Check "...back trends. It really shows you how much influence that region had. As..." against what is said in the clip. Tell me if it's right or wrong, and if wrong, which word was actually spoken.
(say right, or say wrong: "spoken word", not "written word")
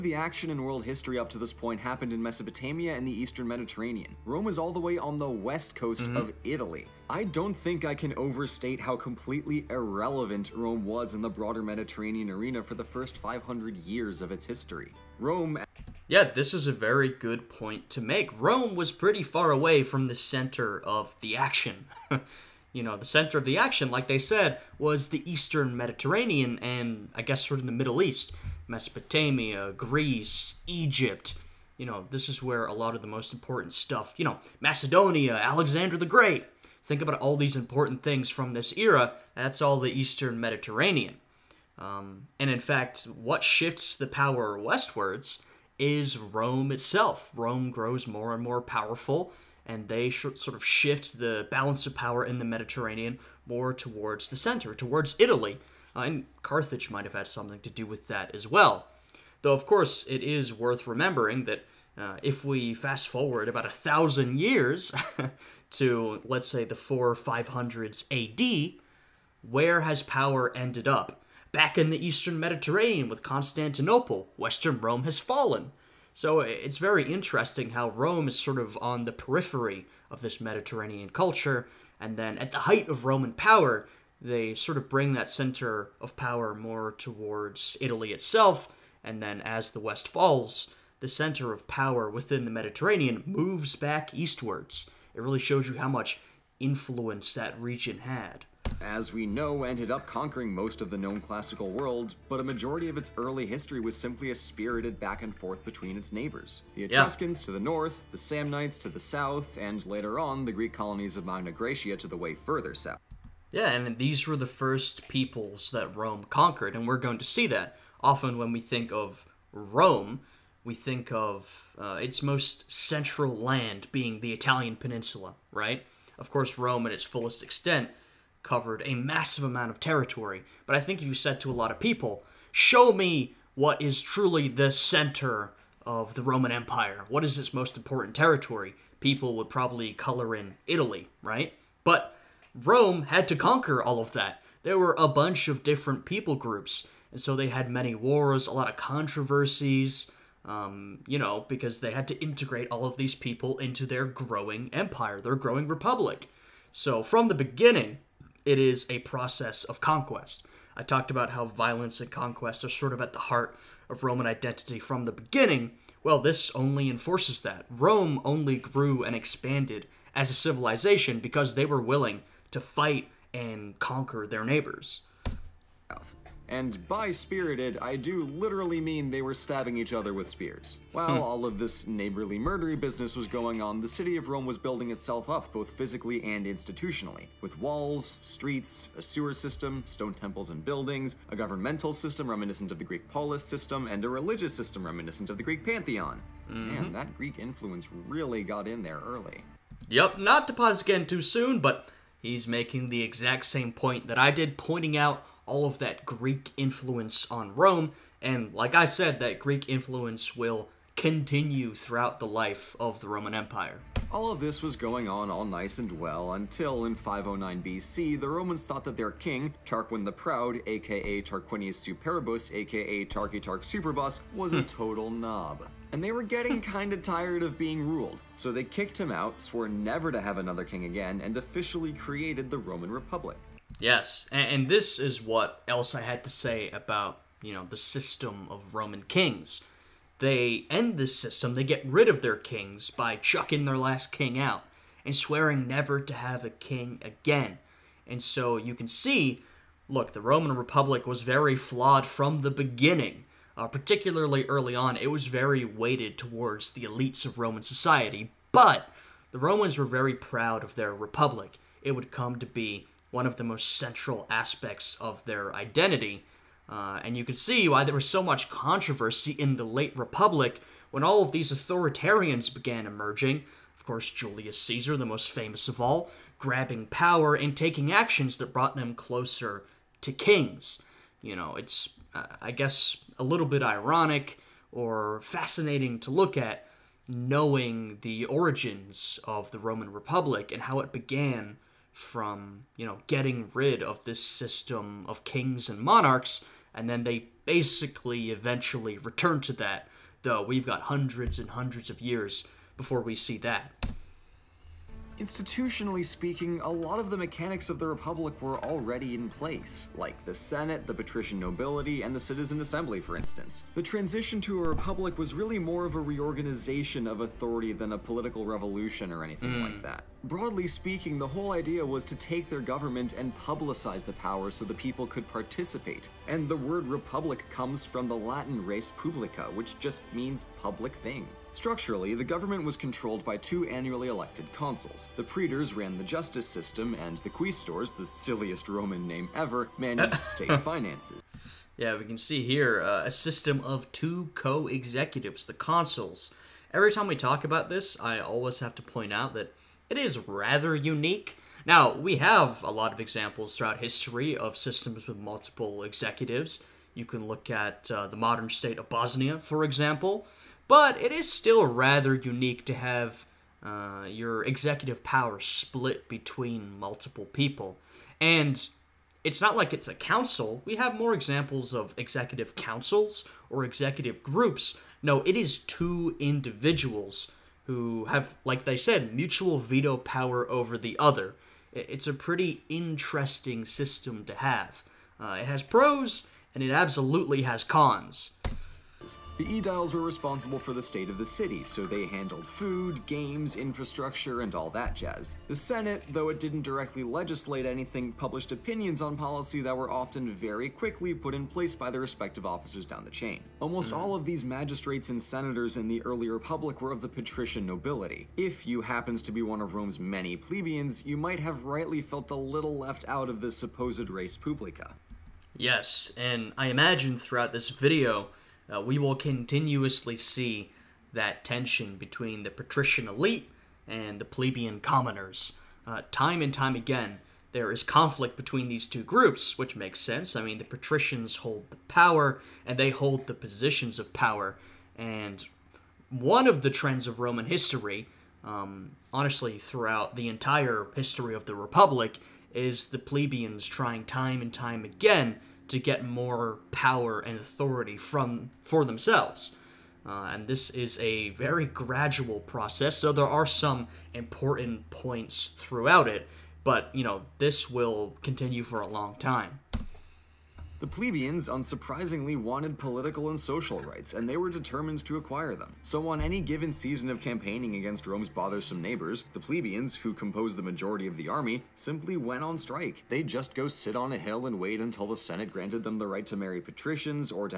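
wrong: "eastwards", not "trends".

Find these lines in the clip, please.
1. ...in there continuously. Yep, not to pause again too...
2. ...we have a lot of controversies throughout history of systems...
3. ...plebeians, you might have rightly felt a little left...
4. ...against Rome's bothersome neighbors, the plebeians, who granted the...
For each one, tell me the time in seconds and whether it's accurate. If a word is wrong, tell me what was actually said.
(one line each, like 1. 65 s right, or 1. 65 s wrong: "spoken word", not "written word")
1. 198 s wrong: "early", not "continuously"
2. 351 s wrong: "examples", not "controversies"
3. 410 s right
4. 467 s wrong: "composed", not "granted".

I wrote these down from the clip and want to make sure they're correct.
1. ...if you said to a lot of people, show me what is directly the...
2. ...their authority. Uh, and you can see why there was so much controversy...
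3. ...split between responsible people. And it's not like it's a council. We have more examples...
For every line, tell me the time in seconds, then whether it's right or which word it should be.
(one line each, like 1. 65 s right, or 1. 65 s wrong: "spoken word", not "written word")
1. 131 s wrong: "truly", not "directly"
2. 265 s wrong: "identity", not "authority"
3. 365 s wrong: "multiple", not "responsible".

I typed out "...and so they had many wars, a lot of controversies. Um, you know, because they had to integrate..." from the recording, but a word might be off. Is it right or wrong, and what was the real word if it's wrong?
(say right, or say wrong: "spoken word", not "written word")
right.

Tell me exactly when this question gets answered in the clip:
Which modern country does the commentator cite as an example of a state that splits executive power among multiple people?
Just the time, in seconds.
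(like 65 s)
358 s.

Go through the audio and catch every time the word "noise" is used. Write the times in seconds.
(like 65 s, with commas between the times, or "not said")
not said.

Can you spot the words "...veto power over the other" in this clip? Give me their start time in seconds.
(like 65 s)
379 s.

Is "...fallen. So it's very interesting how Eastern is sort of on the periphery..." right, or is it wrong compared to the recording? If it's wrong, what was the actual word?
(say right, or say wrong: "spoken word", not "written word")
wrong: "Rome", not "Eastern".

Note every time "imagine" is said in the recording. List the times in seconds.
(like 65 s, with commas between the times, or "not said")
416 s.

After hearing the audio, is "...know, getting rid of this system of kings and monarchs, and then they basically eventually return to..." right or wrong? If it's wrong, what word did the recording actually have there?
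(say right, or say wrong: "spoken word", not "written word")
right.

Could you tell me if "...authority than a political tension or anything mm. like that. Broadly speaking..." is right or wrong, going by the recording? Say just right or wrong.
wrong.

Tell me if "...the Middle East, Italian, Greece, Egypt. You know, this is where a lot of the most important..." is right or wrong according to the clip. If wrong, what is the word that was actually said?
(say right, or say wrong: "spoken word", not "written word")
wrong: "Mesopotamia", not "Italian".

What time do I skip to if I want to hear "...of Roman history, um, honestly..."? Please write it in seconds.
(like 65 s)
437 s.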